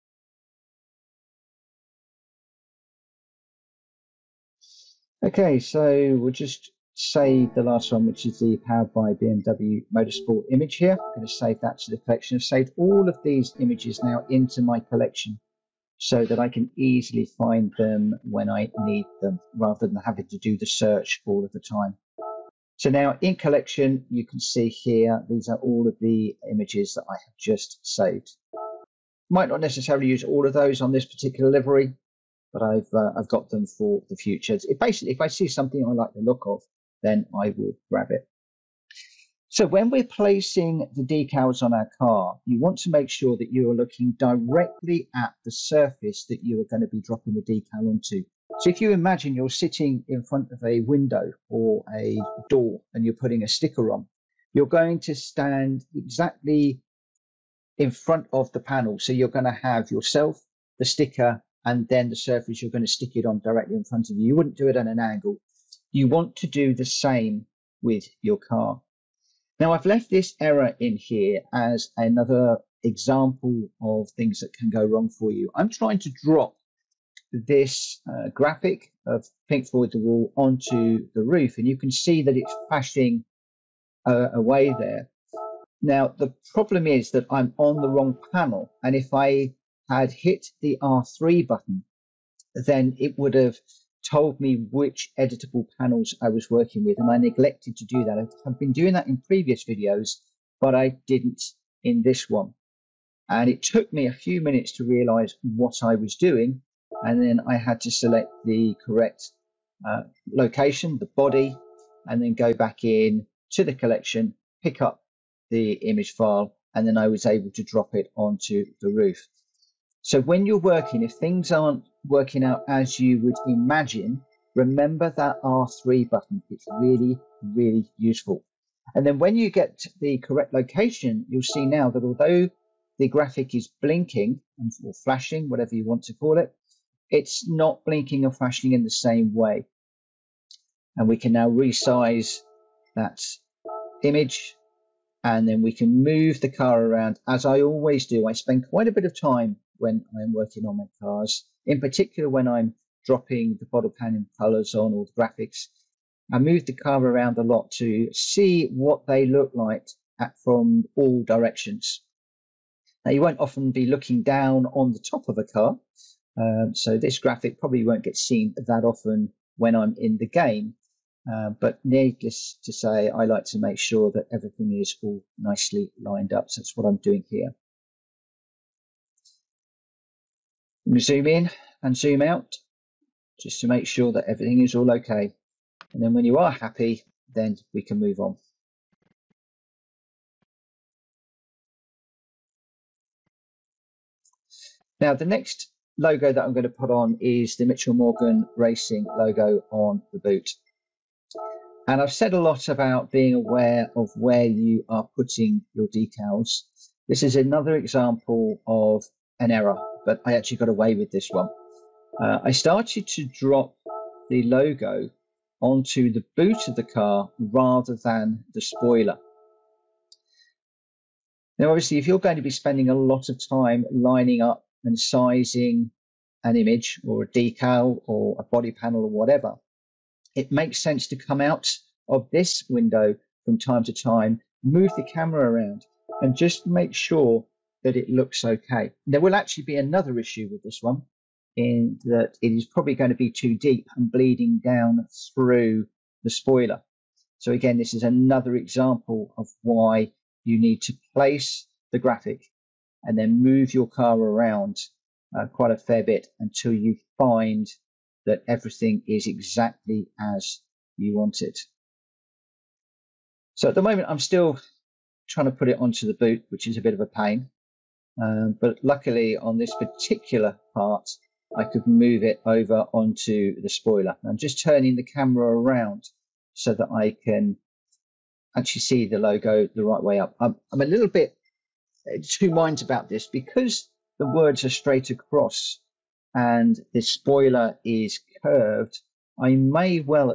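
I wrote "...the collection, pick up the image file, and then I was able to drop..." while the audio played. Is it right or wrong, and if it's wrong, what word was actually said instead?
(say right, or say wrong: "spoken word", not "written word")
right.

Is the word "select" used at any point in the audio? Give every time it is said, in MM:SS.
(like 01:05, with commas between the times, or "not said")
01:47.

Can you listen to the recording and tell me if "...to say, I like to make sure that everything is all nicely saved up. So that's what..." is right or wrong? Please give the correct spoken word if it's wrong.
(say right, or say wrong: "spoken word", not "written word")
wrong: "lined", not "saved".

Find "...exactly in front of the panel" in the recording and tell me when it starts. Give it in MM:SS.
00:55.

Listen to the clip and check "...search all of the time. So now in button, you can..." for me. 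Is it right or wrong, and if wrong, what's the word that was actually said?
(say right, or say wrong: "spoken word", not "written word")
wrong: "collection", not "button".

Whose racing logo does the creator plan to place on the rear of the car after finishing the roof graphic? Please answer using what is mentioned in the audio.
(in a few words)
Mitchell Morgan Racing.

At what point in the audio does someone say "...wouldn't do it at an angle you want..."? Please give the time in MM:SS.
01:04.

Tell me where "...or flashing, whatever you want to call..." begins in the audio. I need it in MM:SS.
02:14.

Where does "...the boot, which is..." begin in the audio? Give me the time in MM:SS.
04:26.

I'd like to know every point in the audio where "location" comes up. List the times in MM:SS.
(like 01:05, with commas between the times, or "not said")
01:50, 02:10.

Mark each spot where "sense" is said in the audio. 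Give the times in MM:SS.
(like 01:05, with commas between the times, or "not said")
03:50.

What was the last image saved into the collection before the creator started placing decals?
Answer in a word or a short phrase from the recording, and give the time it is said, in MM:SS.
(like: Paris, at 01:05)
powered by BMW Motorsport, at 00:08.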